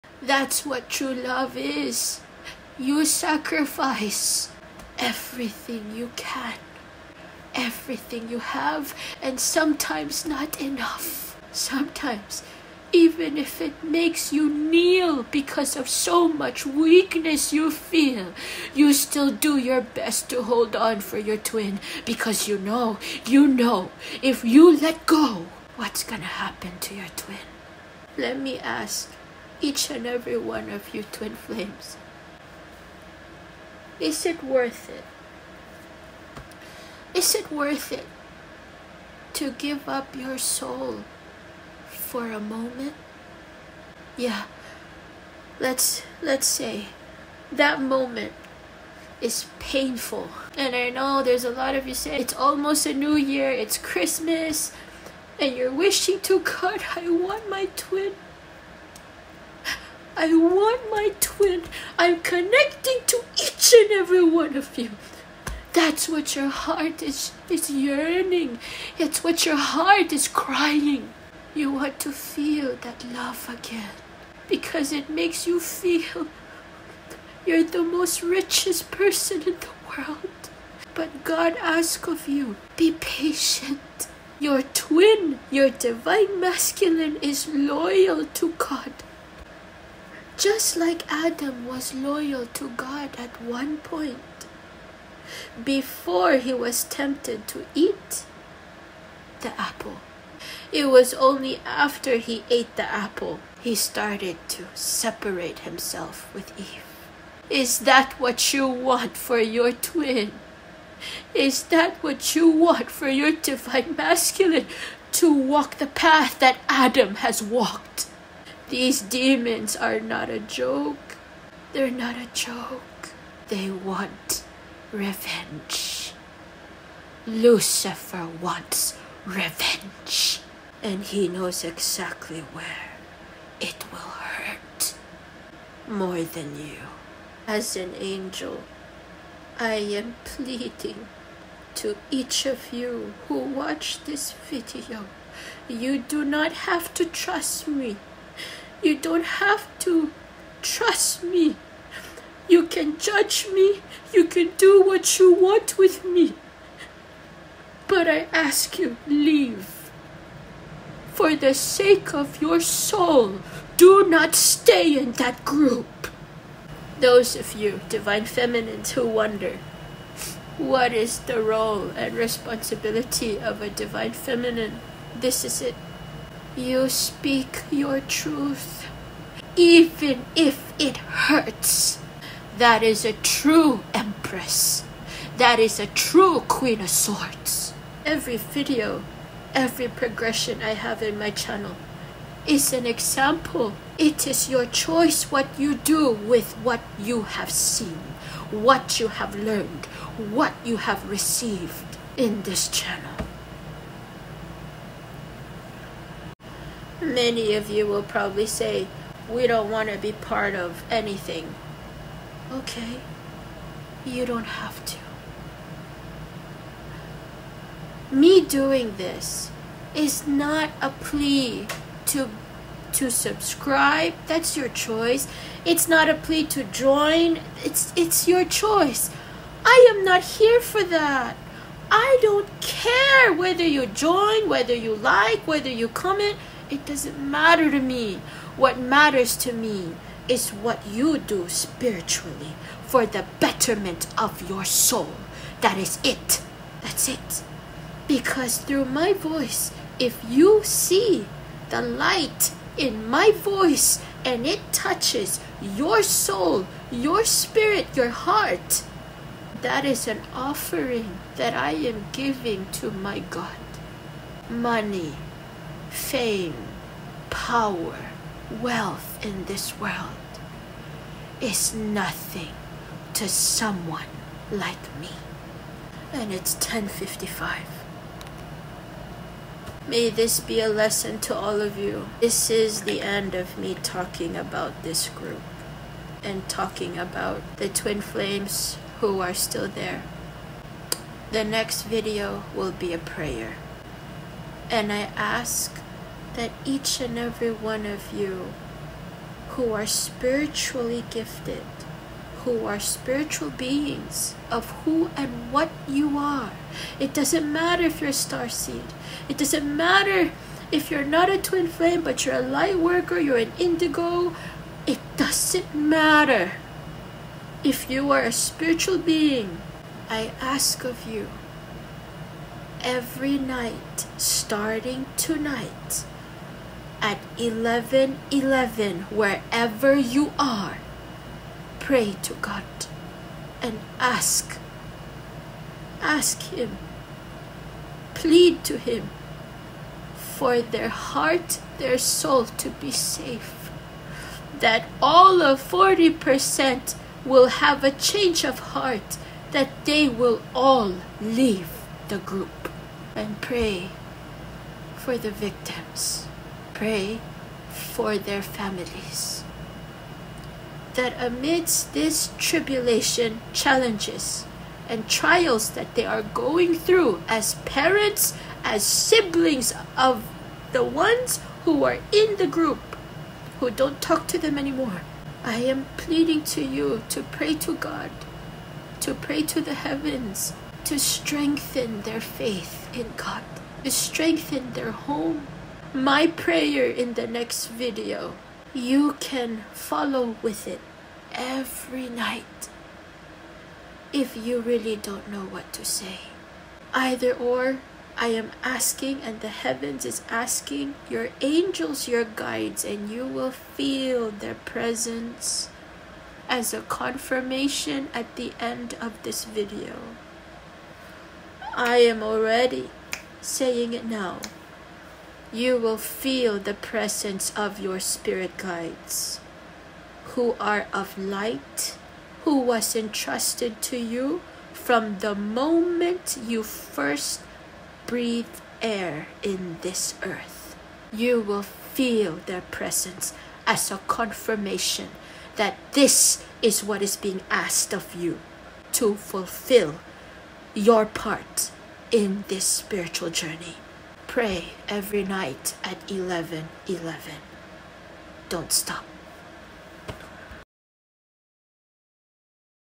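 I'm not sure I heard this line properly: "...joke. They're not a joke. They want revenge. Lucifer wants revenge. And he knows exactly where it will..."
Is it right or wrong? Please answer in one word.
right.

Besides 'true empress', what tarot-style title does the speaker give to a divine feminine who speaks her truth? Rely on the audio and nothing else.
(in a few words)
queen of swords.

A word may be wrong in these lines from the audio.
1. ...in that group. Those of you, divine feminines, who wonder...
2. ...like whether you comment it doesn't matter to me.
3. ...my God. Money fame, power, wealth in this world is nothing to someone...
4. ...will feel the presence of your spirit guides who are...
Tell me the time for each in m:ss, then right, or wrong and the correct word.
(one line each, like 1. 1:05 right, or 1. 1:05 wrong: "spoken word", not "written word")
1. 2:44 right
2. 3:54 right
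3. 4:22 right
4. 6:55 right.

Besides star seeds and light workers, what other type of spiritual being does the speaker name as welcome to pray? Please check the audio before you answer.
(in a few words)
indigo.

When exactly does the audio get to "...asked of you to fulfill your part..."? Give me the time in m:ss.
7:17.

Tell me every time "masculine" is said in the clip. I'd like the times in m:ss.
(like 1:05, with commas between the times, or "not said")
1:26, 1:53.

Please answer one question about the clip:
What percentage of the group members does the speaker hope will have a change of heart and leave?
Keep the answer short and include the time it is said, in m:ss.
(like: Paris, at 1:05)
40%, at 5:45.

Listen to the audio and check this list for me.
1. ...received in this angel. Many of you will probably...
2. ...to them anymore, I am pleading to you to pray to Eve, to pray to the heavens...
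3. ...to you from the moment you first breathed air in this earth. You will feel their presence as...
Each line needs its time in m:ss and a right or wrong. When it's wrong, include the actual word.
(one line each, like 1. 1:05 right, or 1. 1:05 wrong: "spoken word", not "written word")
1. 3:21 wrong: "channel", not "angel"
2. 6:14 wrong: "God", not "Eve"
3. 7:03 right.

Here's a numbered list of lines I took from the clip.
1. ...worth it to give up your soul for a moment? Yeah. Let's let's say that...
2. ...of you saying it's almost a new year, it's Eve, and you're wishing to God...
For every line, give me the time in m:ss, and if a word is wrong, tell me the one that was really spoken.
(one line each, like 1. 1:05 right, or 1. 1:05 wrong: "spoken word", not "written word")
1. 0:37 right
2. 0:51 wrong: "Christmas", not "Eve".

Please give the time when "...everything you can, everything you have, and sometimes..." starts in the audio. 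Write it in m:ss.
0:04.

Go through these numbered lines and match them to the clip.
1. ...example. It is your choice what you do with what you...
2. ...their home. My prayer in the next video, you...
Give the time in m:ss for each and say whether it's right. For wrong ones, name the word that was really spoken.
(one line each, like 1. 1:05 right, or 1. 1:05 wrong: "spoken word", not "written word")
1. 3:12 right
2. 6:24 right.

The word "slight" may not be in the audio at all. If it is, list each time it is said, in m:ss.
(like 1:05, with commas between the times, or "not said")
not said.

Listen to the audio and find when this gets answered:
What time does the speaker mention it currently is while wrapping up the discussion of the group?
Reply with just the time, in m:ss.
4:36.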